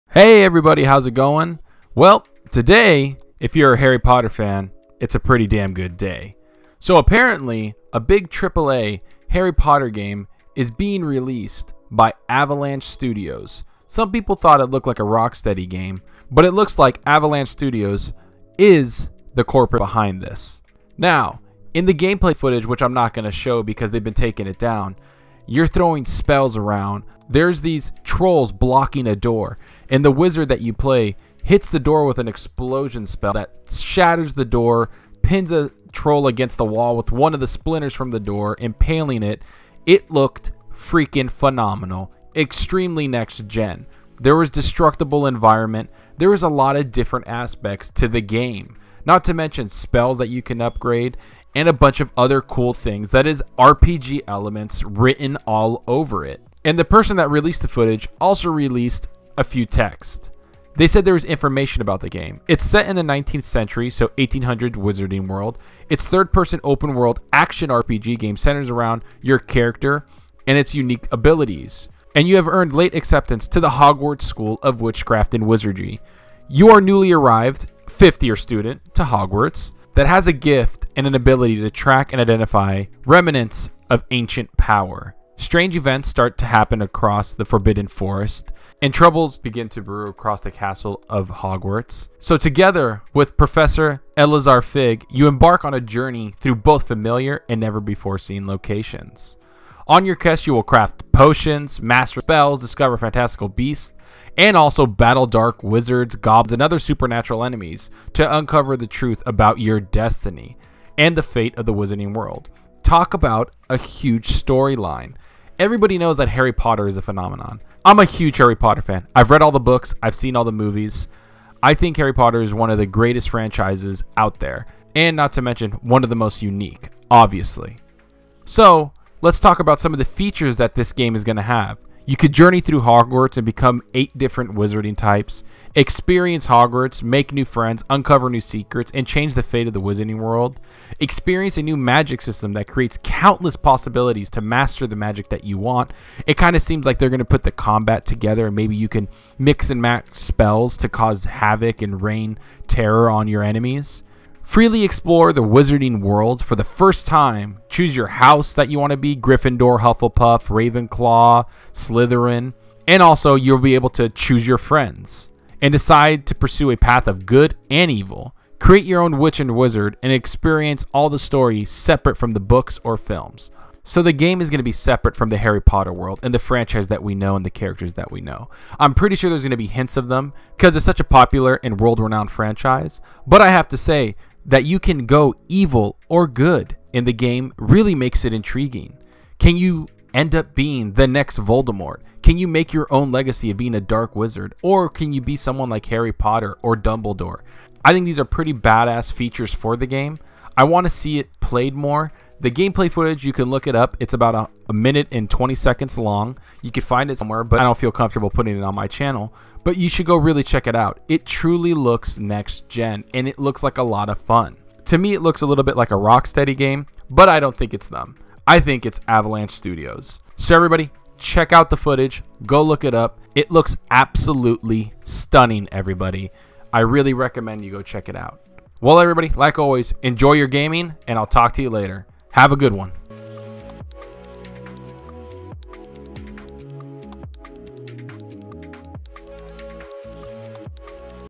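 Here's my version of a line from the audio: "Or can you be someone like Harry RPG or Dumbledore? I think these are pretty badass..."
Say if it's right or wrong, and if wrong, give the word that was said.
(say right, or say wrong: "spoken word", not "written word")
wrong: "Potter", not "RPG".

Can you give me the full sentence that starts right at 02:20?
Experience a new magic system that creates countless possibilities to master the magic that you want.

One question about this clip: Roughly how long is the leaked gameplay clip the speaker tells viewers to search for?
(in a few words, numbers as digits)
1 minute 20 seconds.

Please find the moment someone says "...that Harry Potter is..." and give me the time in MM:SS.
01:56.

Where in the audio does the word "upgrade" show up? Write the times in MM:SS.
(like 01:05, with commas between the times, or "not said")
00:50.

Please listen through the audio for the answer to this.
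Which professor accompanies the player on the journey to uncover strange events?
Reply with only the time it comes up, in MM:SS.
01:34.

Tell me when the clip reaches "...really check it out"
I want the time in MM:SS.
03:30.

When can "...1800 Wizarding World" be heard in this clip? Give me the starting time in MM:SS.
01:04.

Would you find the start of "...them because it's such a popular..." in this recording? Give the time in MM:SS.
03:00.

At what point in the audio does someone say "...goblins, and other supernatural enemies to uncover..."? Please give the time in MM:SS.
01:46.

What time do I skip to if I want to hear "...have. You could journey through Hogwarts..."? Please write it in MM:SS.
02:11.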